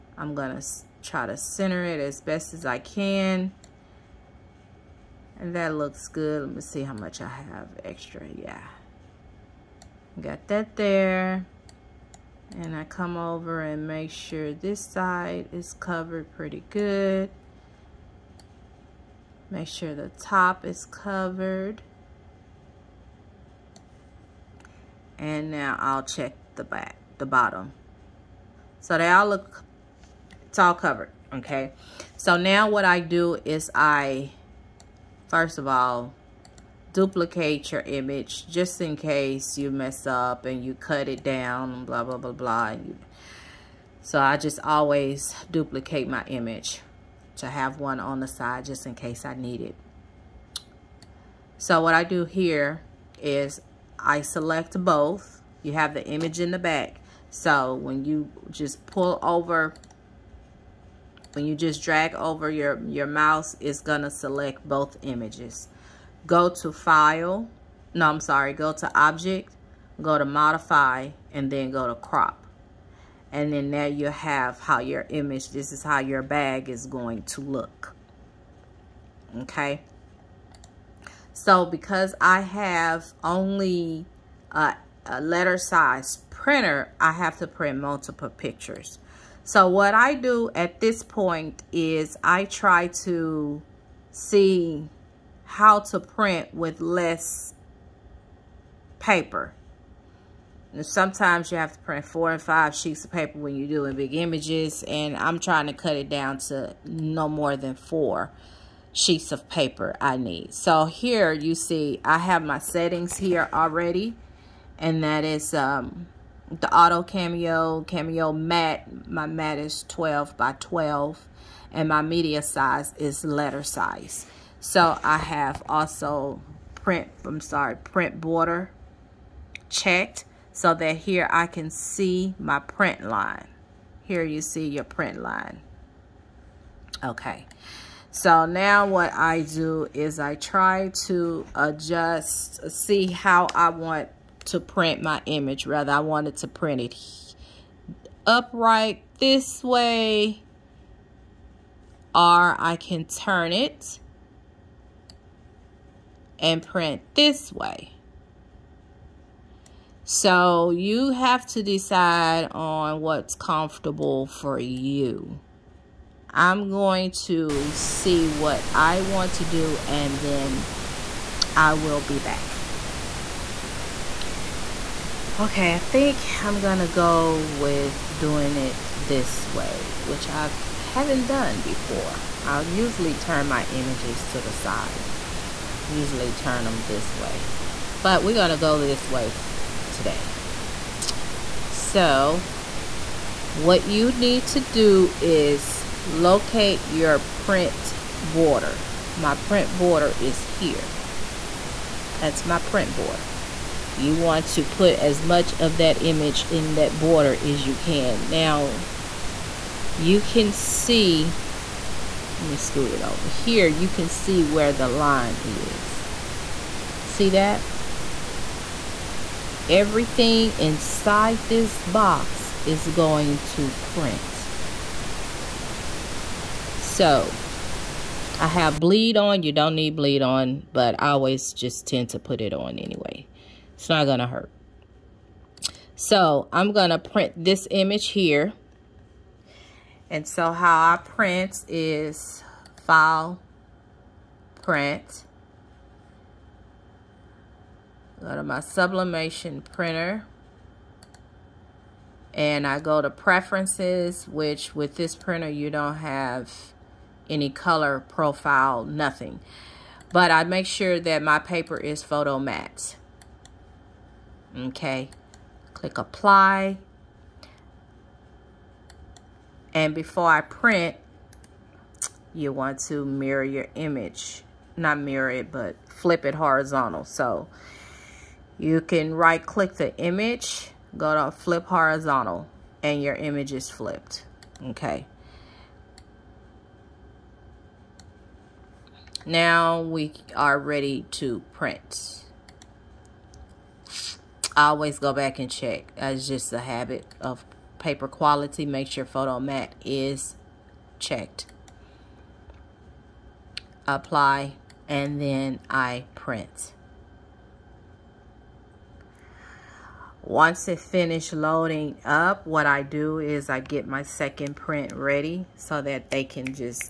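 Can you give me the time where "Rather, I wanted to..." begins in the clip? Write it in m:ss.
2:25.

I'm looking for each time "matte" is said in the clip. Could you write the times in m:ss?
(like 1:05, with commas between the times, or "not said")
4:22, 4:59.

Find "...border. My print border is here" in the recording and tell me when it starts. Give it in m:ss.
3:18.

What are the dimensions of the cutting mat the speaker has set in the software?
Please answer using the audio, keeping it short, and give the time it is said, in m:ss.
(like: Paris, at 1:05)
12 by 12, at 1:59.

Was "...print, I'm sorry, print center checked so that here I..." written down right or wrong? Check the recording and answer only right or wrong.
wrong.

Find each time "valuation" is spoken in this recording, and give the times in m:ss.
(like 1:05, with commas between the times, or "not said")
not said.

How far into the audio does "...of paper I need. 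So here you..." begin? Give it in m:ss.
1:49.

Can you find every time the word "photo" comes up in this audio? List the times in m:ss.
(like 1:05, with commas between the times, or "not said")
4:22, 4:59.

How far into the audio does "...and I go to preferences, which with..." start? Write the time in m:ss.
4:12.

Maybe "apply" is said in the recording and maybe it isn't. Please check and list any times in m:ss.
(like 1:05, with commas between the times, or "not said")
4:25, 5:03.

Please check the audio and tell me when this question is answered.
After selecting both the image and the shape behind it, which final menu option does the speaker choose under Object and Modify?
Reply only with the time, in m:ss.
1:11.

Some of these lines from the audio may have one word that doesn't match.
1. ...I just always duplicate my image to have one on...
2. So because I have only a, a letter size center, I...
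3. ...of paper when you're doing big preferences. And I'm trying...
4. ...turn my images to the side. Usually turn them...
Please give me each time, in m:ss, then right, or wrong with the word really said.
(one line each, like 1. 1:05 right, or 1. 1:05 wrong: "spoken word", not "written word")
1. 0:44 right
2. 1:21 wrong: "printer", not "center"
3. 1:43 wrong: "images", not "preferences"
4. 3:03 right.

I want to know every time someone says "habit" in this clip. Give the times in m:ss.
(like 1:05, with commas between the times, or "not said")
4:56.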